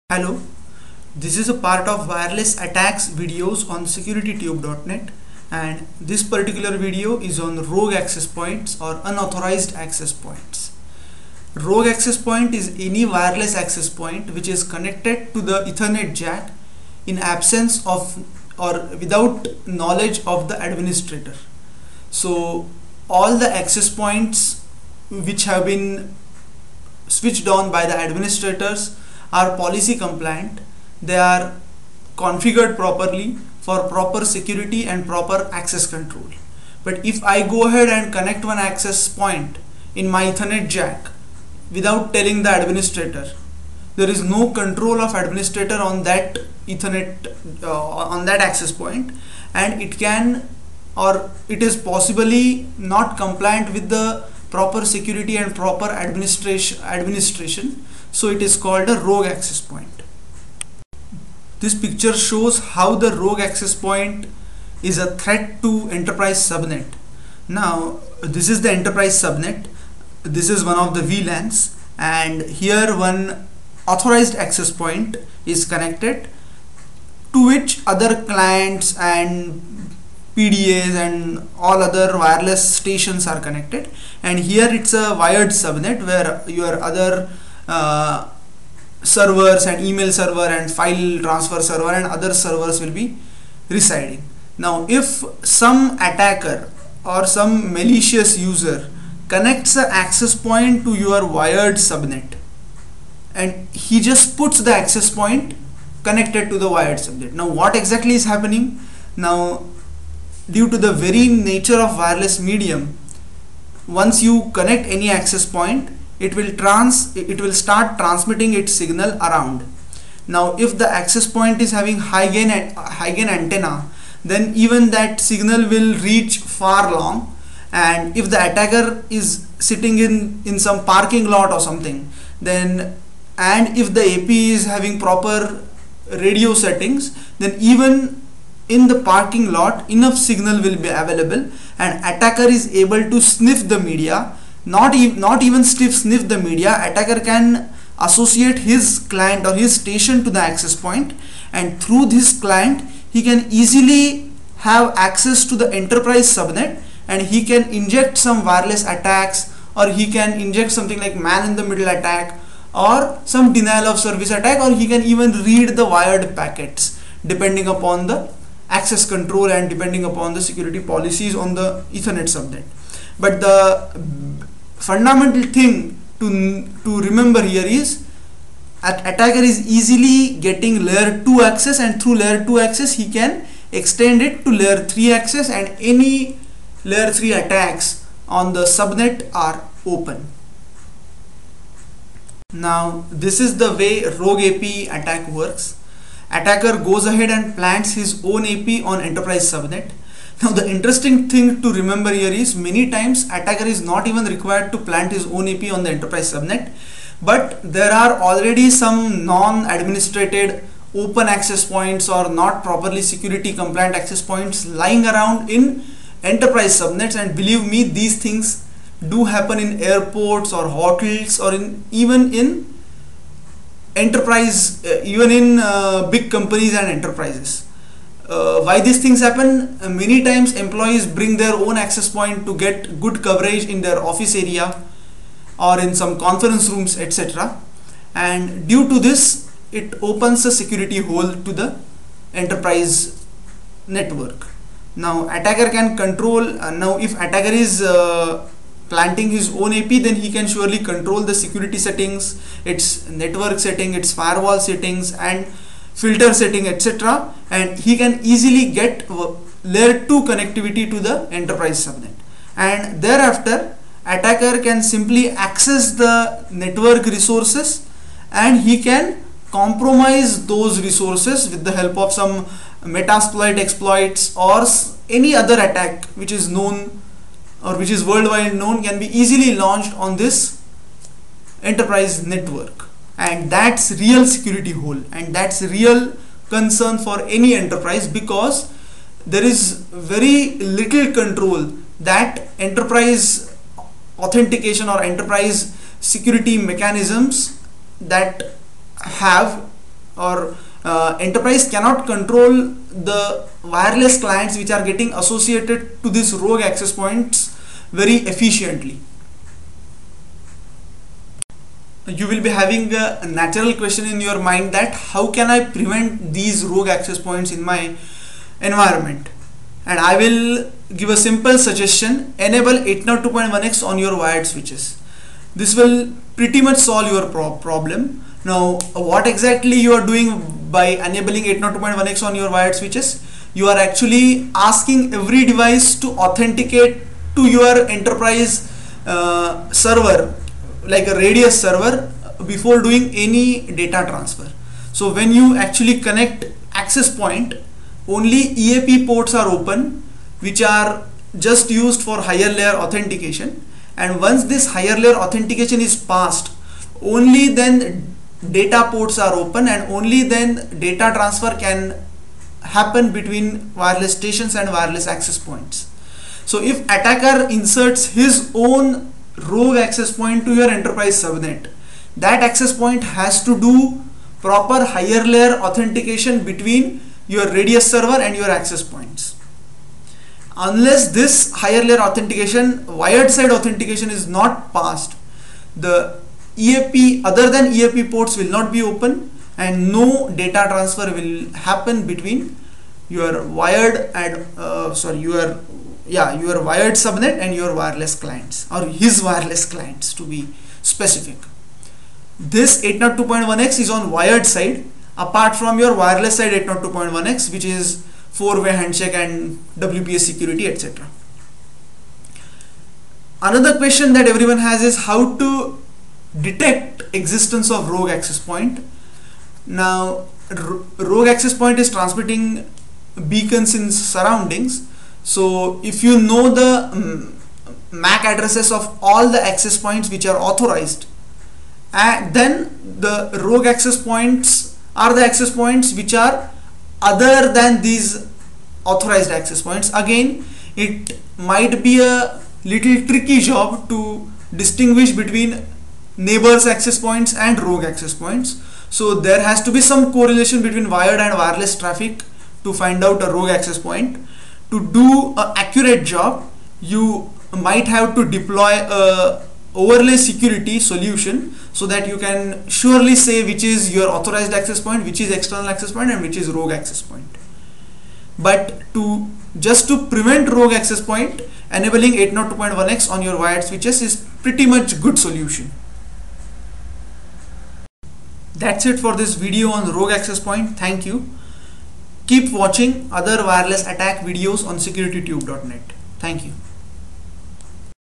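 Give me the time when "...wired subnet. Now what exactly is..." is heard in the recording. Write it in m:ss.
1:46.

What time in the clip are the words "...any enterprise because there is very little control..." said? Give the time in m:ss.
4:47.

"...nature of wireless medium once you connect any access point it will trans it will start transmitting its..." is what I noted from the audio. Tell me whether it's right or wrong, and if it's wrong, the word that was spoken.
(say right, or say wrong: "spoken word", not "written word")
right.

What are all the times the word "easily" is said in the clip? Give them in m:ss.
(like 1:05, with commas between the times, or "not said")
2:33, 2:59, 4:18, 4:39.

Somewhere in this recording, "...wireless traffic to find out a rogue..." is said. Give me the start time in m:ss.
7:31.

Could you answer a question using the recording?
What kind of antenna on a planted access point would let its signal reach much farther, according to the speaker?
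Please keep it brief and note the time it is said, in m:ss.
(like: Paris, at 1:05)
high gain antenna, at 2:02.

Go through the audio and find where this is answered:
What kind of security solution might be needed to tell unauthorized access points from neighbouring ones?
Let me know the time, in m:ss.
7:39.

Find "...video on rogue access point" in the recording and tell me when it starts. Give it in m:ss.
7:59.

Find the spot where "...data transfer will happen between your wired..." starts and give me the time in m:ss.
6:30.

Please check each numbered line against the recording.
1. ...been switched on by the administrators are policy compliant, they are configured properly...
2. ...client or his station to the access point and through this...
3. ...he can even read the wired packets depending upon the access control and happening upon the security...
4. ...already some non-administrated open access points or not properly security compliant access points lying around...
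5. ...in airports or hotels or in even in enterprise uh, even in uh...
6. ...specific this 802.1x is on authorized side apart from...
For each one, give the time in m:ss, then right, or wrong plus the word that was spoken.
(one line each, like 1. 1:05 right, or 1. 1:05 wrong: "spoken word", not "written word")
1. 0:25 right
2. 2:29 right
3. 2:44 wrong: "depending", not "happening"
4. 3:28 right
5. 3:39 right
6. 6:40 wrong: "wired", not "authorized".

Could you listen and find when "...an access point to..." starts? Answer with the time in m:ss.
1:39.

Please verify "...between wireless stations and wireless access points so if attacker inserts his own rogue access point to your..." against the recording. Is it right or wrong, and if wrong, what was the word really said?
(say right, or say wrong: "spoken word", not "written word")
right.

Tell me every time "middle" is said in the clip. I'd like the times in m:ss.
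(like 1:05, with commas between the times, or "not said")
2:41.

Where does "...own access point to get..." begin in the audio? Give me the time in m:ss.
3:51.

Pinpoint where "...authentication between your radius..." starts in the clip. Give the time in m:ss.
6:15.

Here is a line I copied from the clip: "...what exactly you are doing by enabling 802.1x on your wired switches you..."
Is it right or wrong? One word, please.
right.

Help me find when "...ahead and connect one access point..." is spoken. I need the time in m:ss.
0:37.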